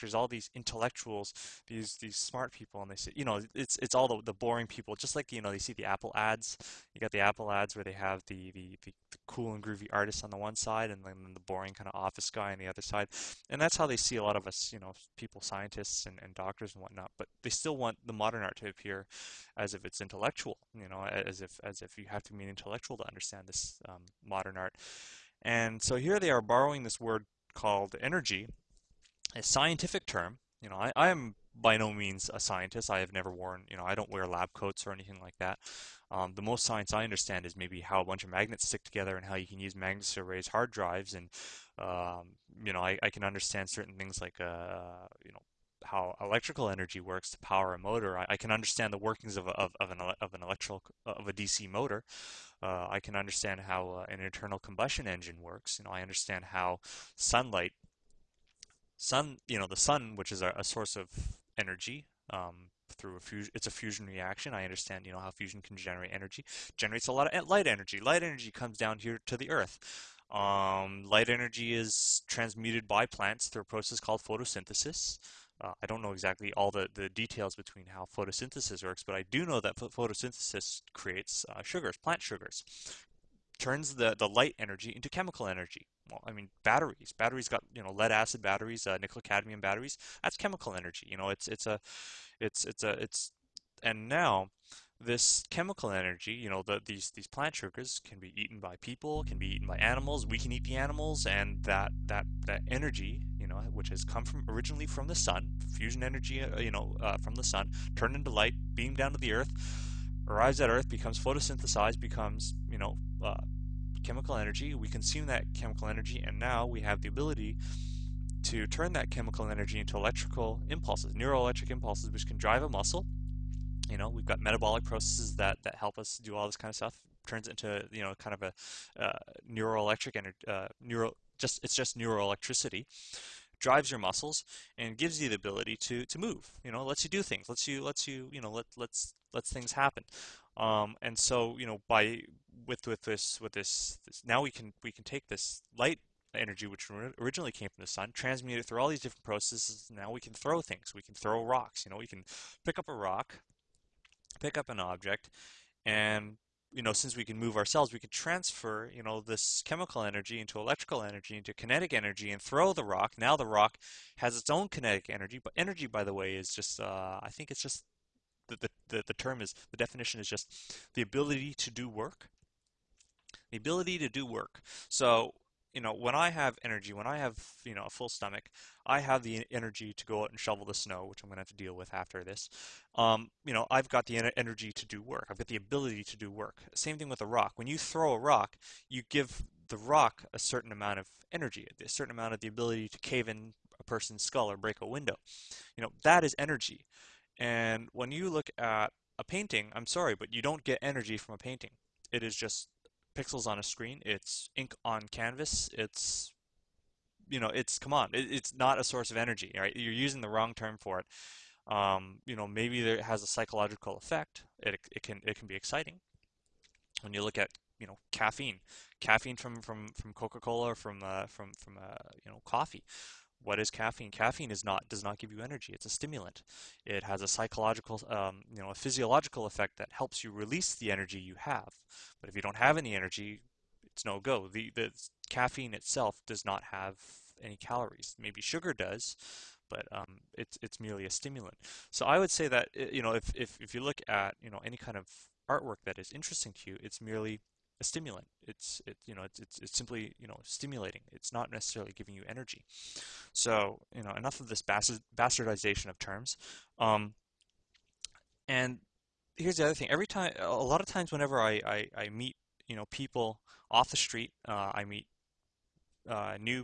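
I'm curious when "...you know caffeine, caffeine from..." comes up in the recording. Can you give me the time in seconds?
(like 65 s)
217 s.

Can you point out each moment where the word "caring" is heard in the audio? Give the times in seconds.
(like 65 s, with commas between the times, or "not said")
not said.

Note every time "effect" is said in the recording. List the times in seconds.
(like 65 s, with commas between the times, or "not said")
213 s, 229 s.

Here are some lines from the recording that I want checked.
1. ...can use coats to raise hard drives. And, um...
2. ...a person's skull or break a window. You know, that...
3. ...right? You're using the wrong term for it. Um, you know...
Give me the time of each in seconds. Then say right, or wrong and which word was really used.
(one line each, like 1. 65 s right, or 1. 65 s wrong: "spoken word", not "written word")
1. 39 s wrong: "magnets", not "coats"
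2. 193 s right
3. 209 s right.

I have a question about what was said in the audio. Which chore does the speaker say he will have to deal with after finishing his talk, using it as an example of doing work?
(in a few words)
shovel the snow.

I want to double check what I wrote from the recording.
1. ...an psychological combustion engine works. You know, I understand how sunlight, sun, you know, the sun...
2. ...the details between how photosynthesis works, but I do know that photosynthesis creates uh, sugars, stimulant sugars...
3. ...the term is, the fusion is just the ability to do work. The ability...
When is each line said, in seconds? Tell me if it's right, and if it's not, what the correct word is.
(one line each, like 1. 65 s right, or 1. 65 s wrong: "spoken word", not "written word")
1. 54 s wrong: "internal", not "psychological"
2. 76 s wrong: "plant", not "stimulant"
3. 169 s wrong: "definition", not "fusion".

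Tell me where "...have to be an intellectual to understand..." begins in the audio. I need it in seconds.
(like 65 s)
22 s.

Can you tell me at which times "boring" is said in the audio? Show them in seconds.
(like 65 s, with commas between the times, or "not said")
4 s, 11 s.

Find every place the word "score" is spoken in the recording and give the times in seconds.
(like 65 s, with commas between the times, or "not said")
not said.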